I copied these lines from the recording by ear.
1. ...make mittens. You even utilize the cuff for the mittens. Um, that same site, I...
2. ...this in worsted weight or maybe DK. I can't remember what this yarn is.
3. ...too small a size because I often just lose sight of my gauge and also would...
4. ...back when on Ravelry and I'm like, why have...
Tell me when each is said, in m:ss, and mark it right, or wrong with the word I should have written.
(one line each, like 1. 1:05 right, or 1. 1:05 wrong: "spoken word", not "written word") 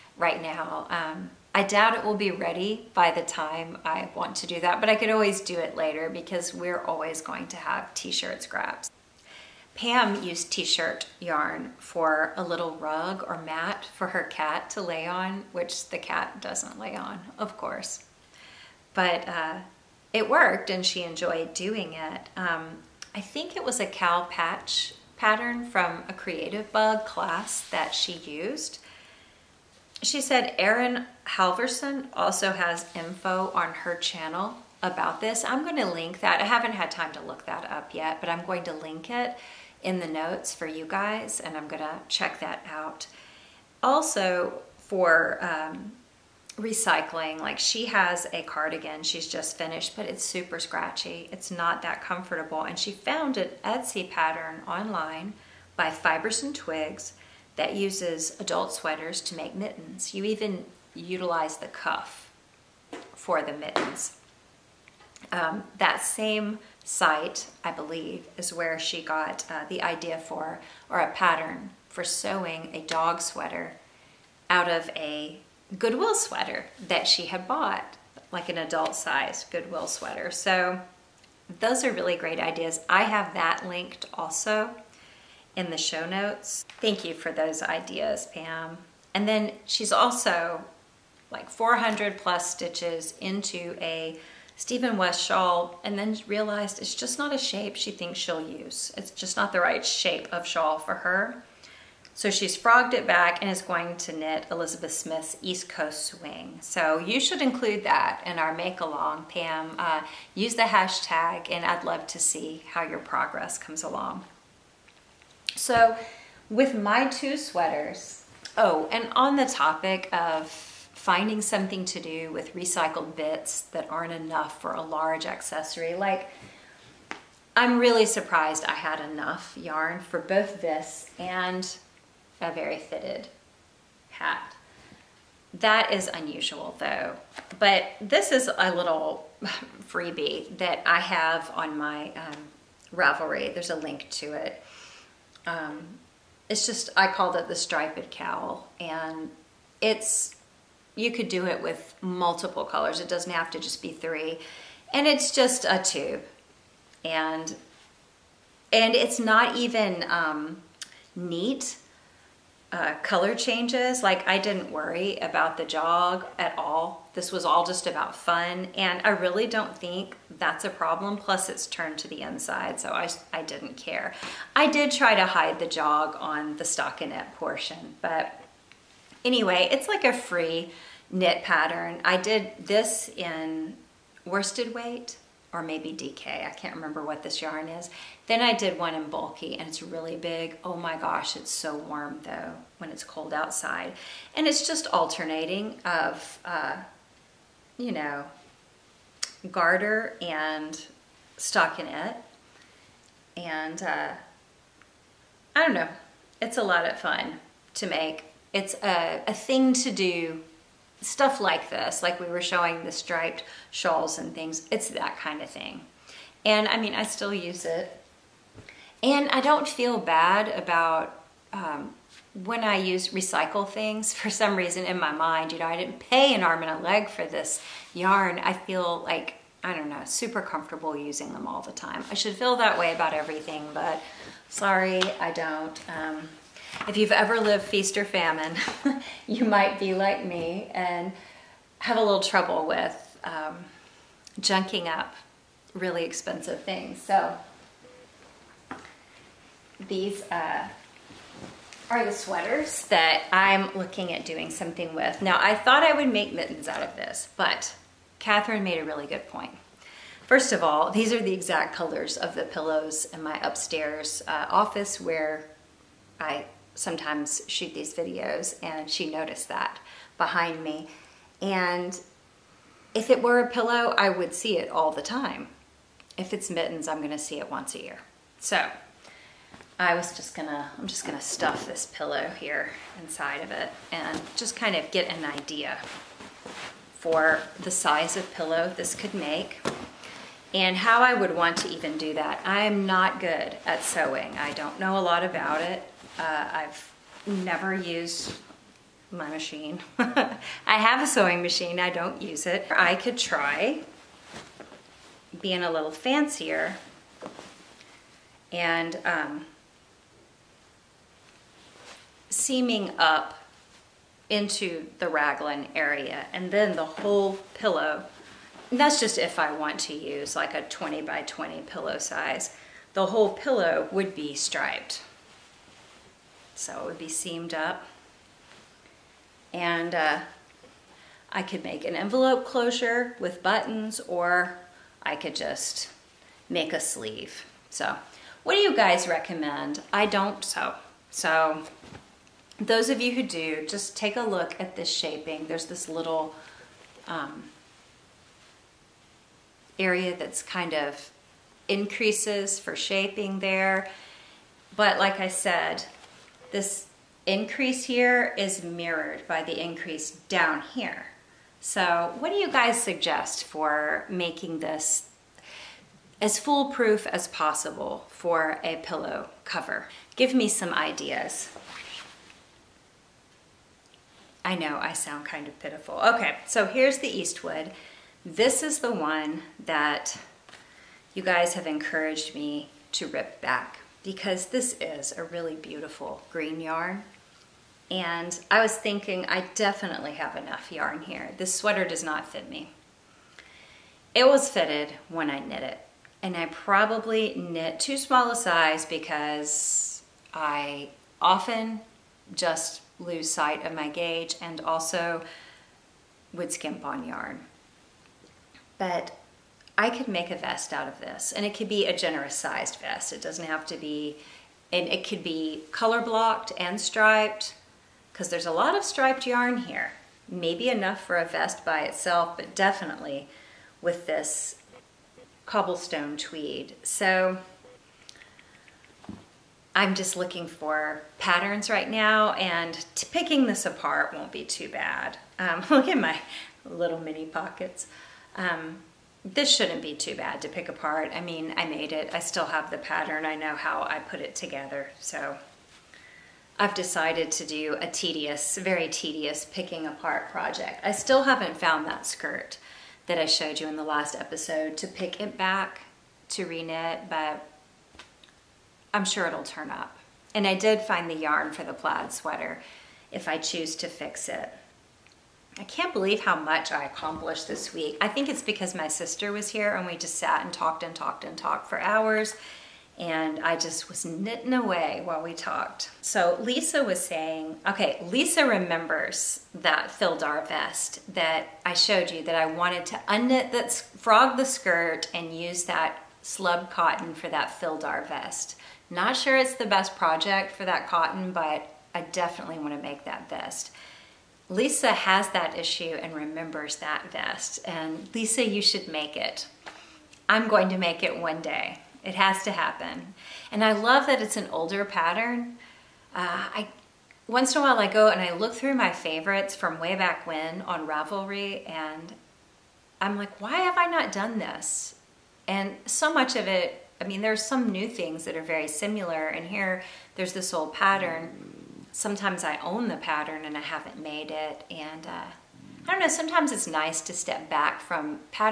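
1. 0:59 right
2. 3:02 right
3. 6:37 right
4. 8:29 right.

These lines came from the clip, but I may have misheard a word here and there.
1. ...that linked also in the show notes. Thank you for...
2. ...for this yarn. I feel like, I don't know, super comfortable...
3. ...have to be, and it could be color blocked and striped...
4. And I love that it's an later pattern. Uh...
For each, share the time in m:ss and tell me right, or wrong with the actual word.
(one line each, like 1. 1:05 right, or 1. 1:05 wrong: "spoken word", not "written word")
1. 1:23 right
2. 3:47 right
3. 6:53 right
4. 8:23 wrong: "older", not "later".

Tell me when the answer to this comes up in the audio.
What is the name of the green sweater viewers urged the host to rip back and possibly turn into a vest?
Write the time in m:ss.
6:17.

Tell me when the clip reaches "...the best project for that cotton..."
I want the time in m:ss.
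8:09.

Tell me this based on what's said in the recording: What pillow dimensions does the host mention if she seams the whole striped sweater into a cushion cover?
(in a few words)
20 by 20.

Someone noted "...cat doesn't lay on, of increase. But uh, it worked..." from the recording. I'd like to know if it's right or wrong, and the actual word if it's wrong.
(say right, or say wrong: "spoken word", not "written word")
wrong: "course", not "increase".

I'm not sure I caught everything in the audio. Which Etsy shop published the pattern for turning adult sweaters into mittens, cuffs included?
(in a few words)
Fibers and Twigs.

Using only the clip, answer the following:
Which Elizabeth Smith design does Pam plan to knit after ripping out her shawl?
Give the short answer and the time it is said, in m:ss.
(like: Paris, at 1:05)
East Coast Swing, at 1:45.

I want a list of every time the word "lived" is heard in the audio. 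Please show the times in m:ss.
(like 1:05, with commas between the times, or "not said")
3:57.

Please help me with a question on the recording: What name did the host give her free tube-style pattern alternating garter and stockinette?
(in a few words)
striped cowl.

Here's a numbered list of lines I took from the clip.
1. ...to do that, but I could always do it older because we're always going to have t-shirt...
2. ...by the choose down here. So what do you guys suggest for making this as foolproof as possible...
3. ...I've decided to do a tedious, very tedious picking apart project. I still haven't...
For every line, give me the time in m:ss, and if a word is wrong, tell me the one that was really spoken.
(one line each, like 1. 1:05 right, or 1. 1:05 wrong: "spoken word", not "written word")
1. 0:04 wrong: "later", not "older"
2. 5:59 wrong: "increase", not "choose"
3. 7:26 right.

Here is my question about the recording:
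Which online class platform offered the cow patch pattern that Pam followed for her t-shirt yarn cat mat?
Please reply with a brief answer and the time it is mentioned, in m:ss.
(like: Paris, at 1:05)
Creativebug, at 0:26.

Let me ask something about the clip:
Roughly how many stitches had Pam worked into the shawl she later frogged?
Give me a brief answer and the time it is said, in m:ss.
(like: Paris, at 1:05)
400 plus, at 1:31.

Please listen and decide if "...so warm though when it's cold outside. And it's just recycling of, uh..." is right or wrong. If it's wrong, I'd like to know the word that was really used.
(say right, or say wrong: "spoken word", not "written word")
wrong: "alternating", not "recycling".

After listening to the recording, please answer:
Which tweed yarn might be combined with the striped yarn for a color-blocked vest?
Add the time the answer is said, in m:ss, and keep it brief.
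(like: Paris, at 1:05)
cobblestone tweed, at 7:05.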